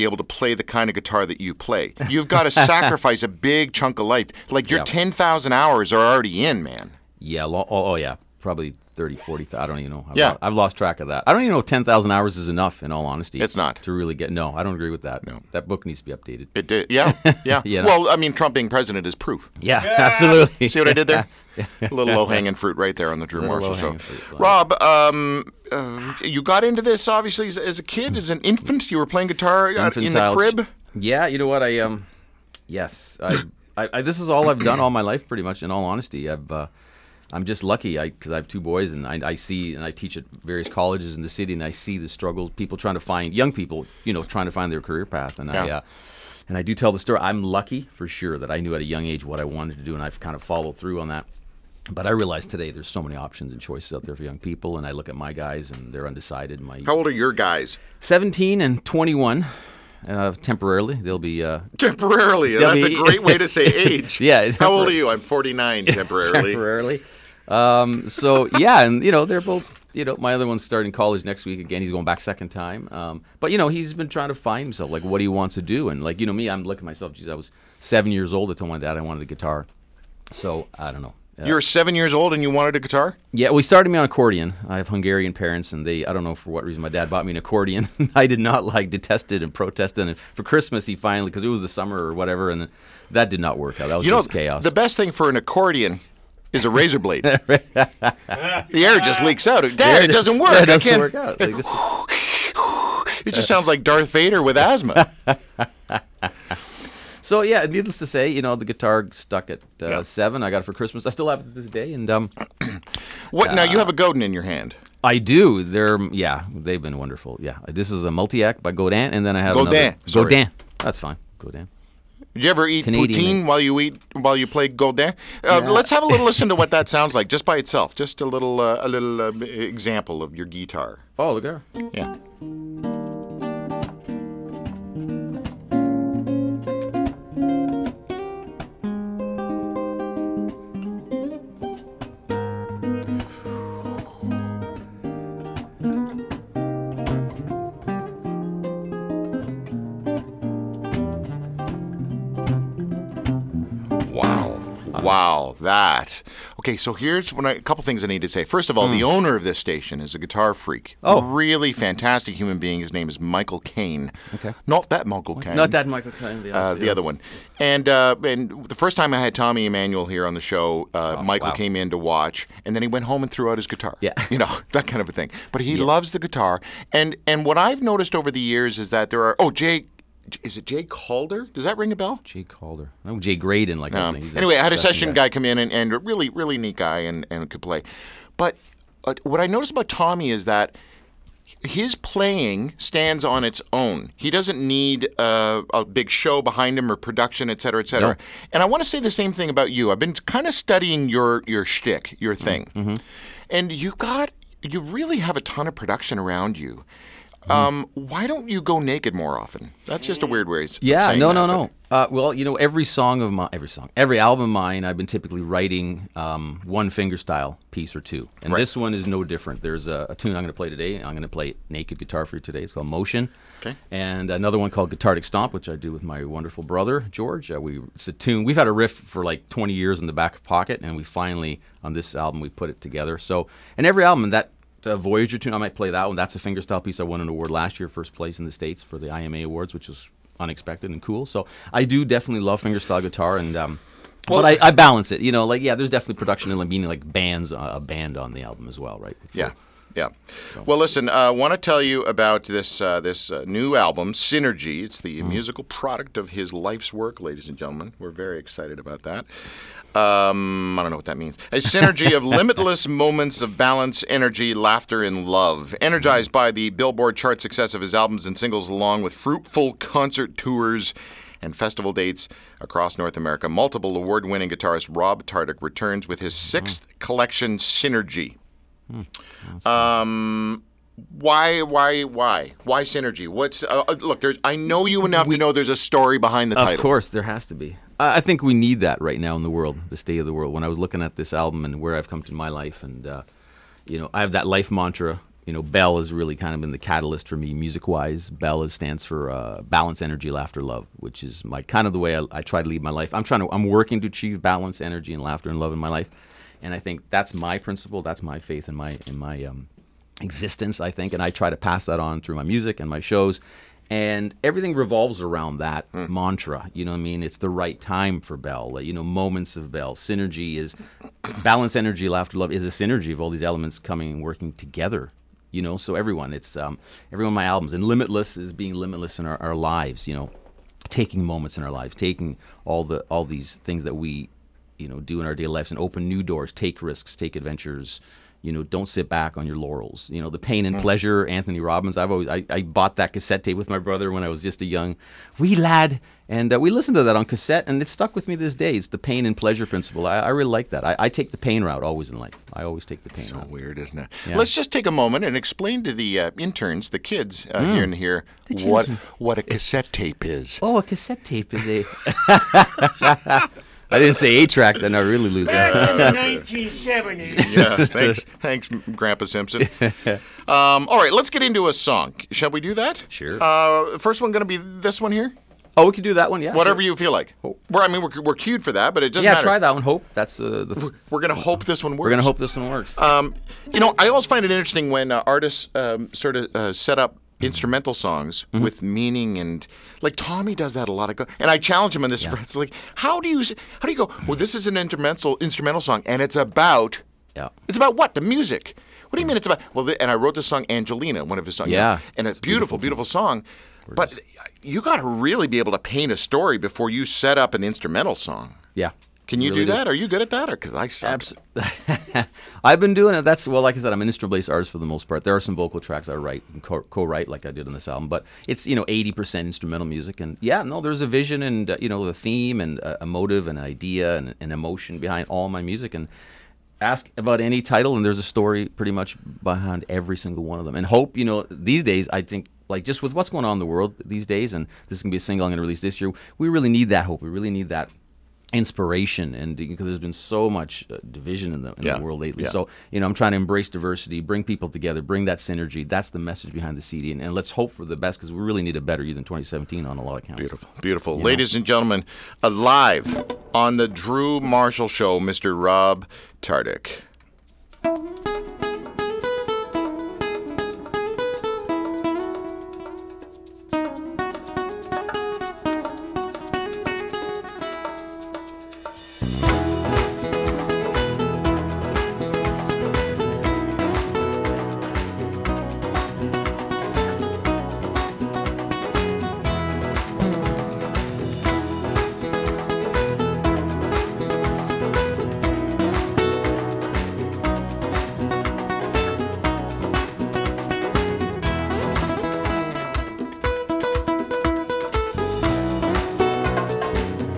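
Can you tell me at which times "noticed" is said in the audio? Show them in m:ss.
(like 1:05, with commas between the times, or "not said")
2:57, 3:09.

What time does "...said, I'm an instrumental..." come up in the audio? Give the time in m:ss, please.
6:53.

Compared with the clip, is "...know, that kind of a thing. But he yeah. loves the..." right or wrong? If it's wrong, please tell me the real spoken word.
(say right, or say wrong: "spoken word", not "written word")
right.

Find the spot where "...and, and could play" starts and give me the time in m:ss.
3:06.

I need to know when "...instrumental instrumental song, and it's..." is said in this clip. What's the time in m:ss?
6:34.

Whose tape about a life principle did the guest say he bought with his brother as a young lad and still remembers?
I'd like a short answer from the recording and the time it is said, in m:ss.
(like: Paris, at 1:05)
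Anthony Robbins, at 5:41.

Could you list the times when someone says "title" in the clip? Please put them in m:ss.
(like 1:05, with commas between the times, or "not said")
4:46, 7:07.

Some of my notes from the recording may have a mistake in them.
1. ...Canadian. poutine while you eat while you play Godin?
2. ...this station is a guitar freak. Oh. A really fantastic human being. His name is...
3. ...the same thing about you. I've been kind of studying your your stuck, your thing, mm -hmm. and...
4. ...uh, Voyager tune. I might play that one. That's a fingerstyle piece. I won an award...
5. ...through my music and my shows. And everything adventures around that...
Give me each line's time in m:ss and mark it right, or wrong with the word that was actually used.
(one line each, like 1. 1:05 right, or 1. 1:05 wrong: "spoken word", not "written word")
1. 2:02 right
2. 2:39 right
3. 3:18 wrong: "shtick", not "stuck"
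4. 3:54 right
5. 5:12 wrong: "revolves", not "adventures".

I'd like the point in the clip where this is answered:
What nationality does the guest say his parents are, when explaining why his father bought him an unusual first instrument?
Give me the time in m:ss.
1:24.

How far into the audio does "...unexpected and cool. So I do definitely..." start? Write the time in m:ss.
4:00.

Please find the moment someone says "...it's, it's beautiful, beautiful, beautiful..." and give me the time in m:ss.
6:42.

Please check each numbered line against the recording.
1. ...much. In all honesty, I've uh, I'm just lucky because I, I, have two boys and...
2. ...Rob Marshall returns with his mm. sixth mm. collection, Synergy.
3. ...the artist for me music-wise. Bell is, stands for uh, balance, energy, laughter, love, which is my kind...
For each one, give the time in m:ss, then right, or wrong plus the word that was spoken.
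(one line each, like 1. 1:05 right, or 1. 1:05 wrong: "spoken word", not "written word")
1. 0:35 right
2. 4:34 wrong: "Tardik", not "Marshall"
3. 4:56 wrong: "catalyst", not "artist".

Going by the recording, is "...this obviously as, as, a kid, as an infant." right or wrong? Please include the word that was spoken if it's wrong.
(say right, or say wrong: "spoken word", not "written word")
right.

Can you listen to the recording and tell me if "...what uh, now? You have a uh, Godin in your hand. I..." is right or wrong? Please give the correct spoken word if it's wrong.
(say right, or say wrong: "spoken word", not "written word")
right.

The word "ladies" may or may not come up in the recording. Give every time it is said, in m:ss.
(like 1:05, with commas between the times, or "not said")
4:17, 7:31.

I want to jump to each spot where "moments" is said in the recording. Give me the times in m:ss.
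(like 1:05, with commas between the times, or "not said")
4:22, 5:19, 5:31, 5:54.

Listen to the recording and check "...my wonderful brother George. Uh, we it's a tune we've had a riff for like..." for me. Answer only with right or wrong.
right.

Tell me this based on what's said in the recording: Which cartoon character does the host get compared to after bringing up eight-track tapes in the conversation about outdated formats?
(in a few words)
Grandpa Simpson.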